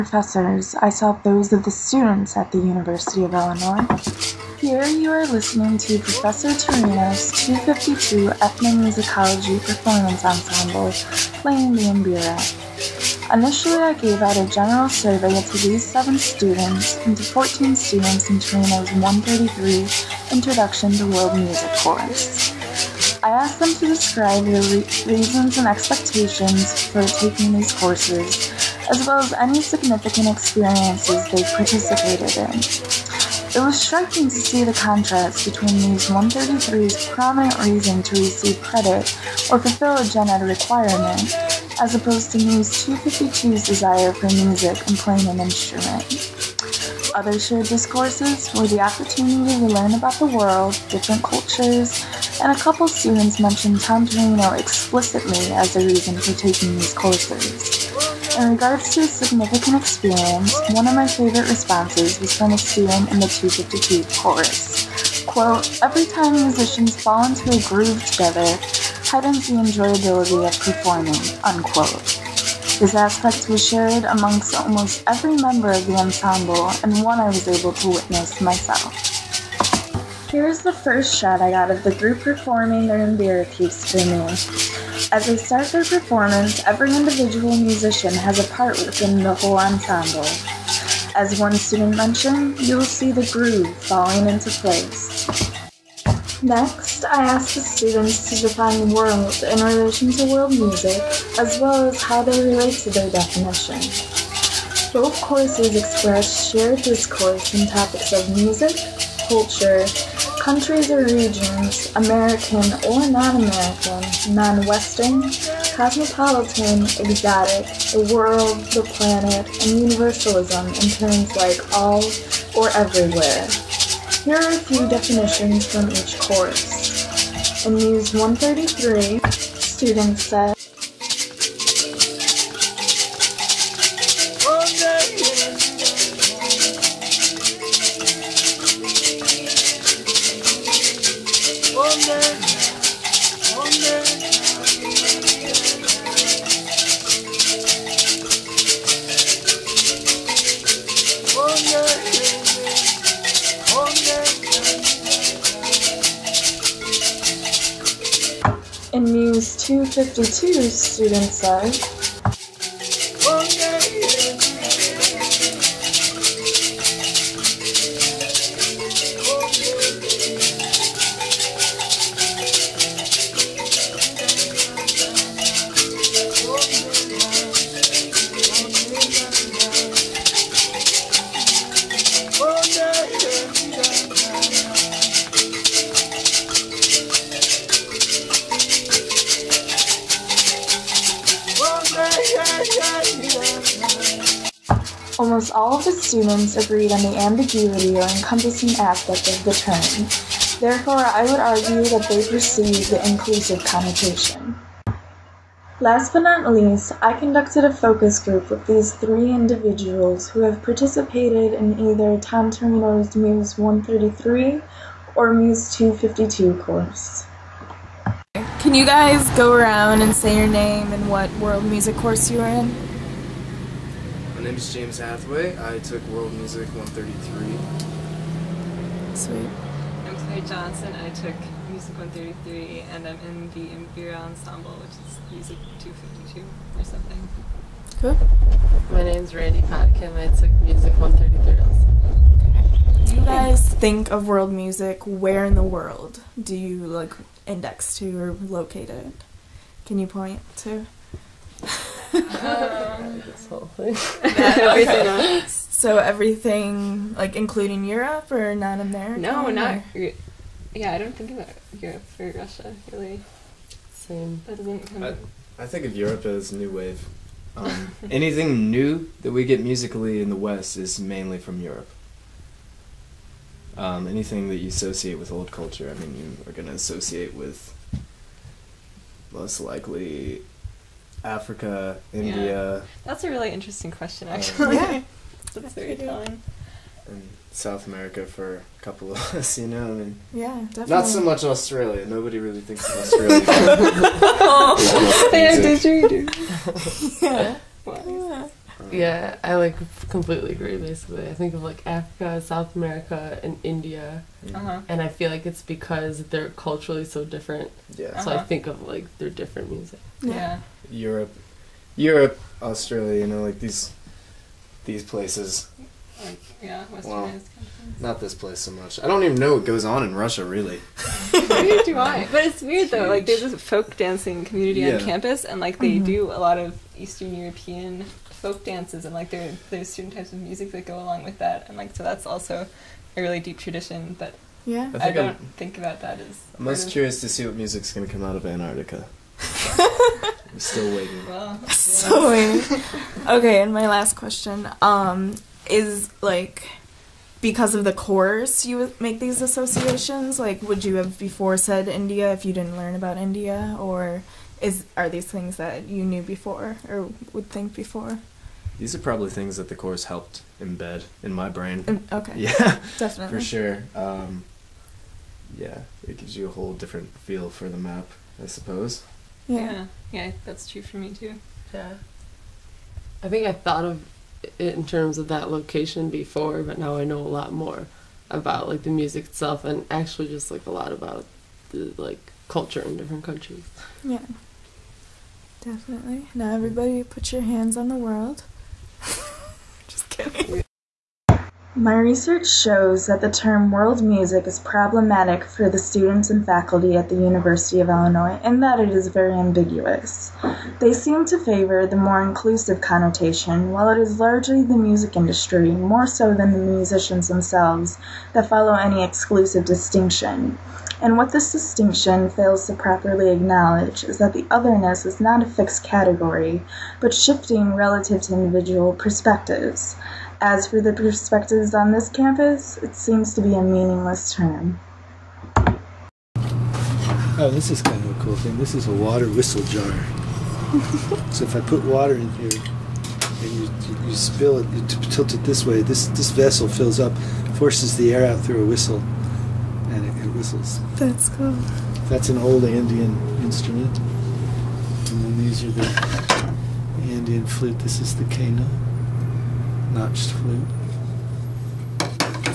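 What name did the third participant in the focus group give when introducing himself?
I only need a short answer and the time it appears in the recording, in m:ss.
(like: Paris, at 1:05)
Randy Potkin, at 3:59.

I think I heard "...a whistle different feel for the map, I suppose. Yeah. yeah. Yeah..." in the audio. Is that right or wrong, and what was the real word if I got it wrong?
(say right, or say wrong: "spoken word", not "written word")
wrong: "whole", not "whistle".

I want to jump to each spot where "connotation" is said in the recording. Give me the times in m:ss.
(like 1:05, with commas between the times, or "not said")
3:23, 6:42.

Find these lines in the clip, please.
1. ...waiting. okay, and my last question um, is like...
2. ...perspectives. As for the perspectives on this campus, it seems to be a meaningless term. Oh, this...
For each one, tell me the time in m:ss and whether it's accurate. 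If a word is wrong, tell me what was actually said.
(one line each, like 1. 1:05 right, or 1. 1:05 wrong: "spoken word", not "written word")
1. 5:42 right
2. 6:58 right.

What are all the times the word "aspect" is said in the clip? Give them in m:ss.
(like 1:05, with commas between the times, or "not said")
1:12, 3:18.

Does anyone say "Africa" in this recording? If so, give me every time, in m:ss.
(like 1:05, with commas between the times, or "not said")
4:41, 5:01.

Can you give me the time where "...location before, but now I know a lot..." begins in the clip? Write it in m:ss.
6:15.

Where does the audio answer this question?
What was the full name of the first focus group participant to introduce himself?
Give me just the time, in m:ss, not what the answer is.
3:44.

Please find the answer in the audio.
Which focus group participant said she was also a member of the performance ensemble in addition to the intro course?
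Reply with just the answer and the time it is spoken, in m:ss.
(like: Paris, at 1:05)
Claire Johnson, at 3:50.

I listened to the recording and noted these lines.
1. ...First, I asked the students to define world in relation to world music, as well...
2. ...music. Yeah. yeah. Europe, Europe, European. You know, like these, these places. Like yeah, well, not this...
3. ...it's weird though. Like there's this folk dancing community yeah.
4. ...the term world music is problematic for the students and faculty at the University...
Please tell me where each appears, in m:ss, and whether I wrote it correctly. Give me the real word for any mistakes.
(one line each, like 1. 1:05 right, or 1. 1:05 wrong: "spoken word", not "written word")
1. 1:37 right
2. 5:09 wrong: "Australia", not "European"
3. 5:22 right
4. 6:33 right.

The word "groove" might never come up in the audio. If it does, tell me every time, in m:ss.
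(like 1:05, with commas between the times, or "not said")
1:07, 1:33.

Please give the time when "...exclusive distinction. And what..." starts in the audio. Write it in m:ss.
6:49.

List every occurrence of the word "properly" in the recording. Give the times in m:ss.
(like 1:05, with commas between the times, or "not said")
6:52.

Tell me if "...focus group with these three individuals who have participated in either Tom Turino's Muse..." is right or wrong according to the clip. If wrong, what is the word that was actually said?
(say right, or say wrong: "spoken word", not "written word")
right.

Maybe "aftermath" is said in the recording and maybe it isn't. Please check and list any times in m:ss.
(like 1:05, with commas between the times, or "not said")
not said.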